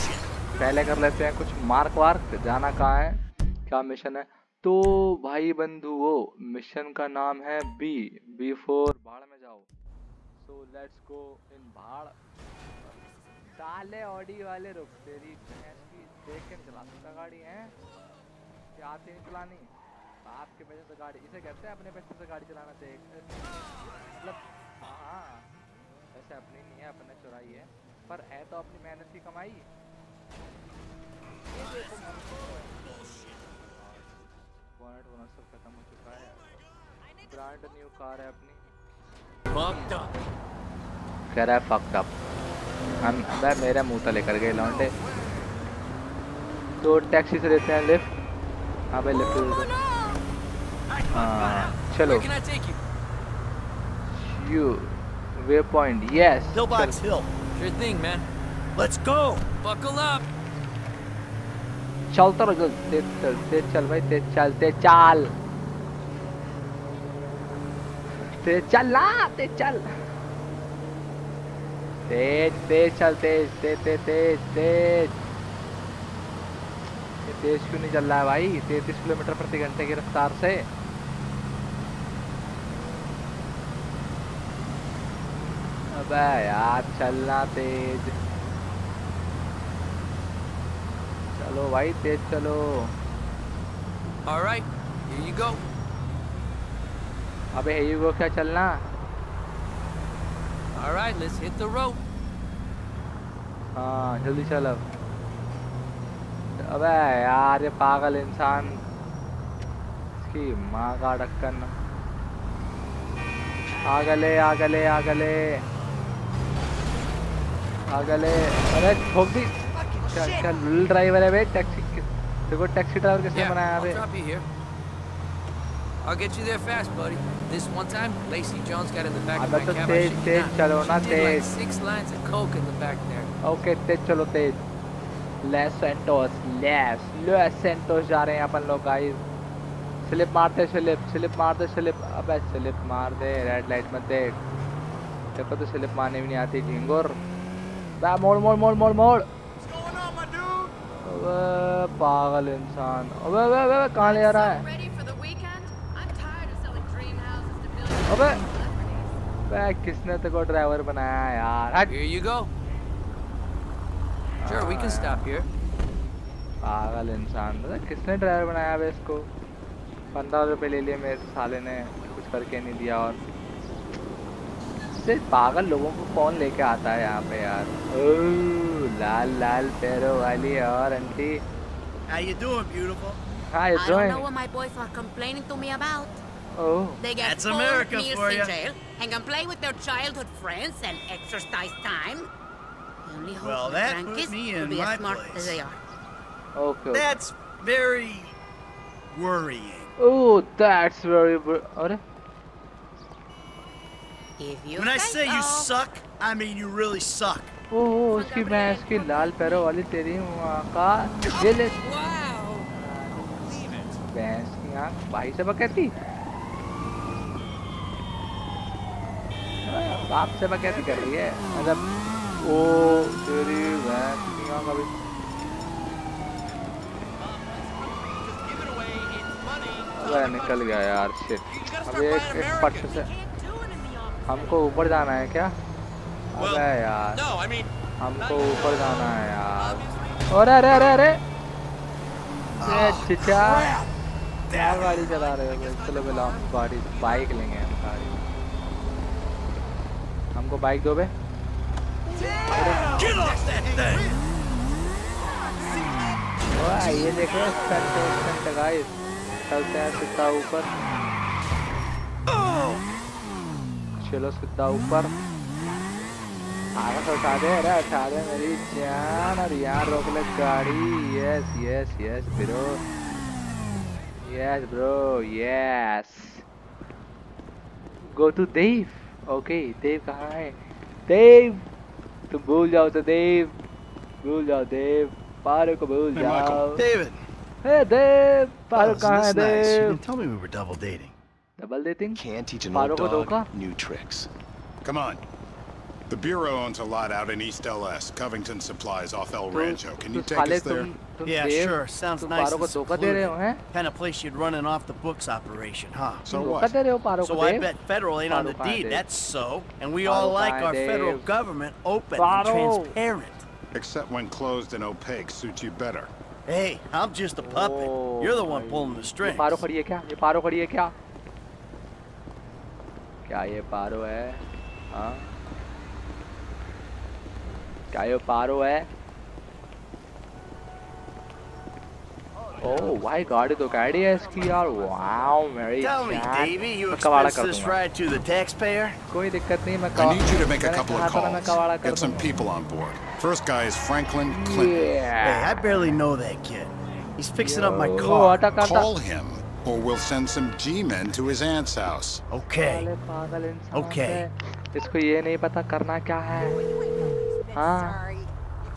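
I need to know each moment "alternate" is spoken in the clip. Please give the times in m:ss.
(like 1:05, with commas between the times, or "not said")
not said.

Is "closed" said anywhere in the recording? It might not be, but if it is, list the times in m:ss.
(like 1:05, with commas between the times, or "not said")
5:14.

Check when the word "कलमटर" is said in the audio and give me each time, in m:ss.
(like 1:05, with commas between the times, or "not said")
1:19.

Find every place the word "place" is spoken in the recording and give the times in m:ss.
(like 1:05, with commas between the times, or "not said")
3:15, 5:03.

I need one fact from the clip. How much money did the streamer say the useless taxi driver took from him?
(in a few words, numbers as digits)
15 rupees.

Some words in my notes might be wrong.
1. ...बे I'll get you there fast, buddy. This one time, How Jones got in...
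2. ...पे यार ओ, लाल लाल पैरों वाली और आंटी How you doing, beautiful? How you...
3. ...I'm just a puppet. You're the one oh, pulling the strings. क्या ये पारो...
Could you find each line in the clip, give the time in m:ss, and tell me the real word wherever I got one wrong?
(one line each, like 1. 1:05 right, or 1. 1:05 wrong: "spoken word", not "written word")
1. 2:03 wrong: "Lacey", not "How"
2. 2:57 right
3. 5:16 right.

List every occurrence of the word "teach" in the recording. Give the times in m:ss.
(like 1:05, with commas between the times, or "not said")
4:52.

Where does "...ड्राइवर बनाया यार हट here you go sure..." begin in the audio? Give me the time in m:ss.
2:40.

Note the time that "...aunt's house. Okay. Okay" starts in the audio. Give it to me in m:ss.
5:51.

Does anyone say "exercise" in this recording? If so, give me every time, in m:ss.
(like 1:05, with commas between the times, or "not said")
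3:11.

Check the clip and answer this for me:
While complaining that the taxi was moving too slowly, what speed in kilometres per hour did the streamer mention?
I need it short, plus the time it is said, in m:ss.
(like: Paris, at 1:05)
33, at 1:18.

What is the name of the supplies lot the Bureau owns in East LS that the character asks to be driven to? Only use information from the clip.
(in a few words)
Covington Supplies.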